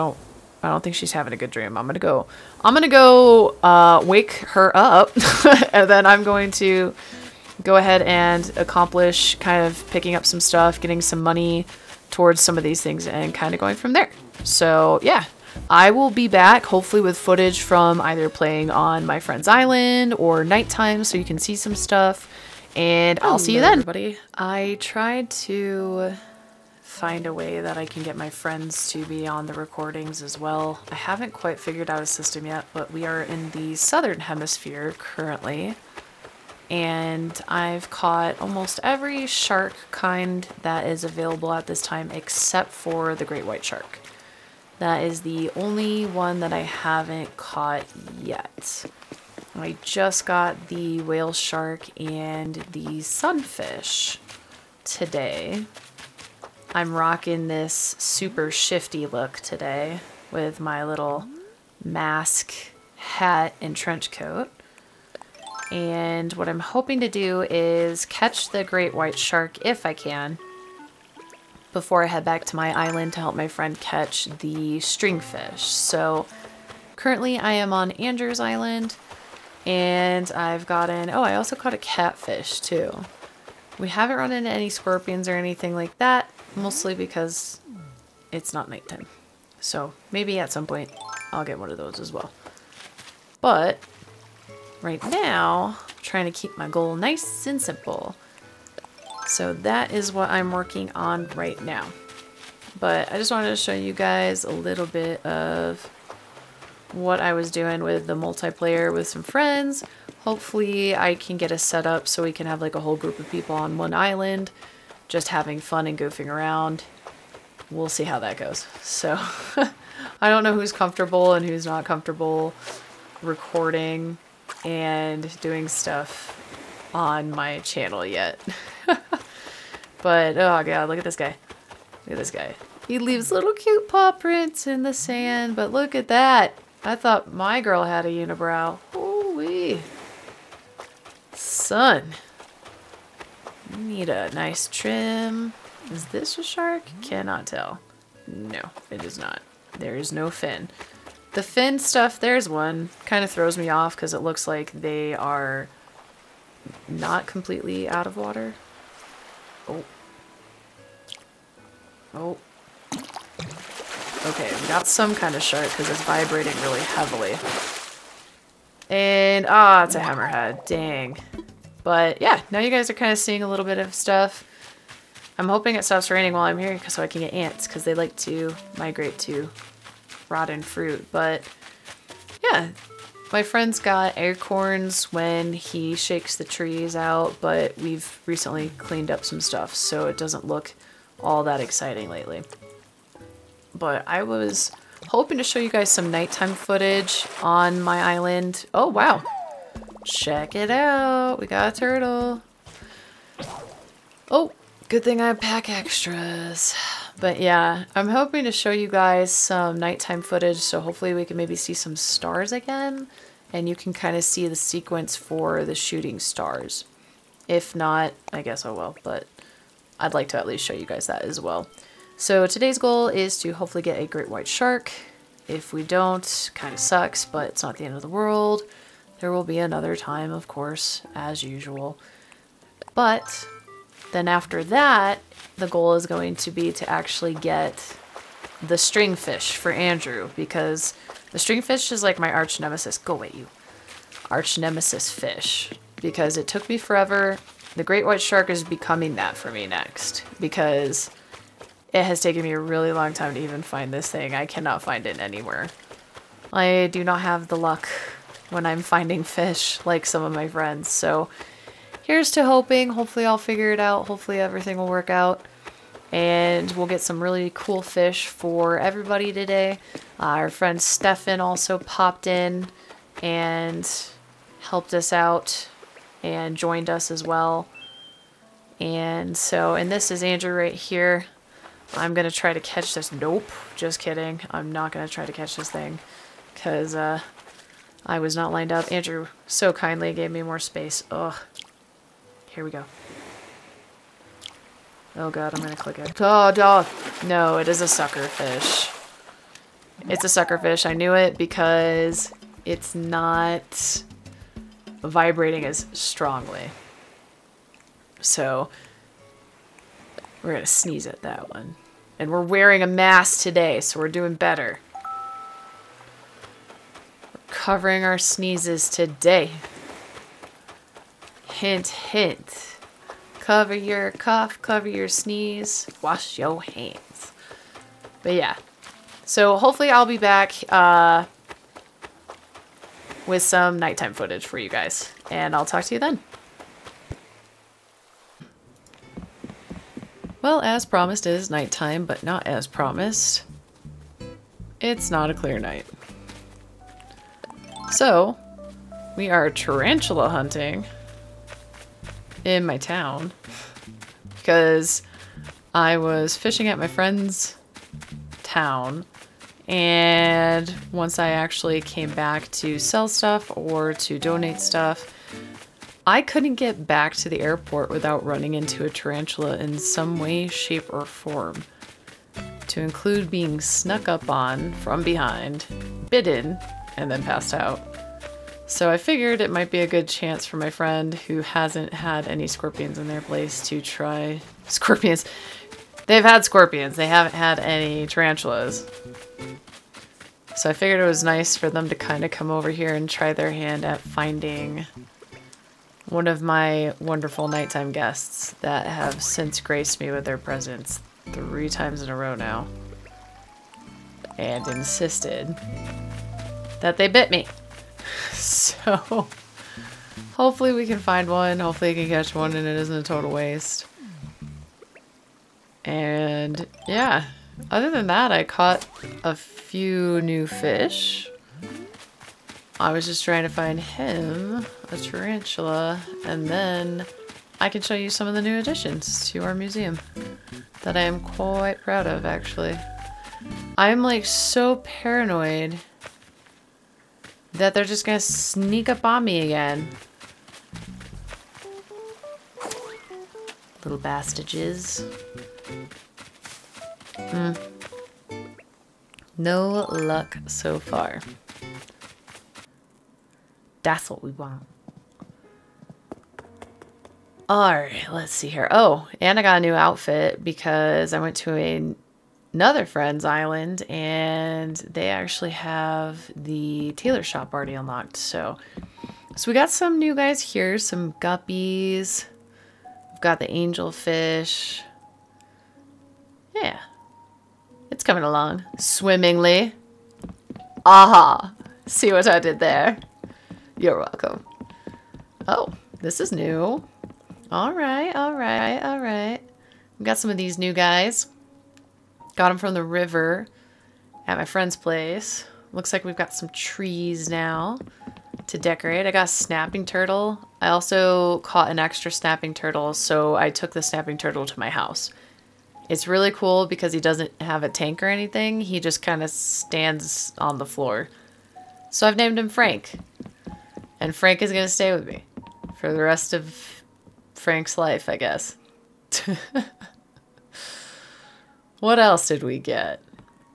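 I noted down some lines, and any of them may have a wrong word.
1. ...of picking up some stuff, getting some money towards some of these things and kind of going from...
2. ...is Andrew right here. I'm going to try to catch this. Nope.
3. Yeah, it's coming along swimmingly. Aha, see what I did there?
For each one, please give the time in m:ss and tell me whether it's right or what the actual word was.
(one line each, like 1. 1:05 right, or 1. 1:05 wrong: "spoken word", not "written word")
1. 0:09 right
2. 4:40 right
3. 7:56 right.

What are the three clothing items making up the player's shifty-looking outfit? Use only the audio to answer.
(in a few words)
Mask, hat, and trench coat.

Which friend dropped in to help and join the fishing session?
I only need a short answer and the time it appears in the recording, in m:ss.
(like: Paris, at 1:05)
Stefan, at 4:30.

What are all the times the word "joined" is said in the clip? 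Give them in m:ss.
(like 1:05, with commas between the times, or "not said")
4:36.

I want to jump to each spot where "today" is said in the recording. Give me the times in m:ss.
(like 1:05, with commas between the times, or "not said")
0:54, 0:59, 3:42, 4:29, 5:13, 5:18.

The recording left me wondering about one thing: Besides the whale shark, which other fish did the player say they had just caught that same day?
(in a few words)
Sunfish.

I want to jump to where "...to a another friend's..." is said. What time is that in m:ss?
7:41.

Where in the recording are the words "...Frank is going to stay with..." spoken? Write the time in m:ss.
8:34.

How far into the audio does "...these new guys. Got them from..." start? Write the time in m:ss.
8:10.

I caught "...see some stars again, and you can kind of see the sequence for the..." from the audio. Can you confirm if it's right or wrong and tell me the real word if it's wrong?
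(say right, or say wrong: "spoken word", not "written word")
right.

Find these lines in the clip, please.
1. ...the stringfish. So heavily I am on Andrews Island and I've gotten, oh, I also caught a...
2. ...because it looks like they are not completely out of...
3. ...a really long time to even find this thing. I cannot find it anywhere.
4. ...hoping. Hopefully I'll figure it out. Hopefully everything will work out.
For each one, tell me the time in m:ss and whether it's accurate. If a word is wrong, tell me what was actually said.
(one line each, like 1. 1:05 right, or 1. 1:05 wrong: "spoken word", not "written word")
1. 1:14 wrong: "currently", not "heavily"
2. 2:33 right
3. 4:12 right
4. 4:22 right.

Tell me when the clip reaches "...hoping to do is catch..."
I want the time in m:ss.
1:06.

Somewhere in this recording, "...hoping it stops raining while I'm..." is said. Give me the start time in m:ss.
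2:55.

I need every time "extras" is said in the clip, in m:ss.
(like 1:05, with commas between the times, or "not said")
3:25, 8:21.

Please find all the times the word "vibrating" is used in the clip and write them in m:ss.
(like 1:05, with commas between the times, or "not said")
2:46, 5:05.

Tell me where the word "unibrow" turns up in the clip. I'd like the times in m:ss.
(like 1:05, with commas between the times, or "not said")
2:18.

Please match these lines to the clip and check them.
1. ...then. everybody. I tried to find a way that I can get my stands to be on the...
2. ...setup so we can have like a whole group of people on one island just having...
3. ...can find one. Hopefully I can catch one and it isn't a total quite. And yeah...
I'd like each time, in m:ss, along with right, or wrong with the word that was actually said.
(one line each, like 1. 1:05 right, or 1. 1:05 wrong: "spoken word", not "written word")
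1. 0:23 wrong: "friends", not "stands"
2. 1:51 right
3. 6:50 wrong: "waste", not "quite".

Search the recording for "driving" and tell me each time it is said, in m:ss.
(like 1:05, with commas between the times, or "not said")
not said.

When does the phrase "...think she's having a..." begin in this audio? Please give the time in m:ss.
0:00.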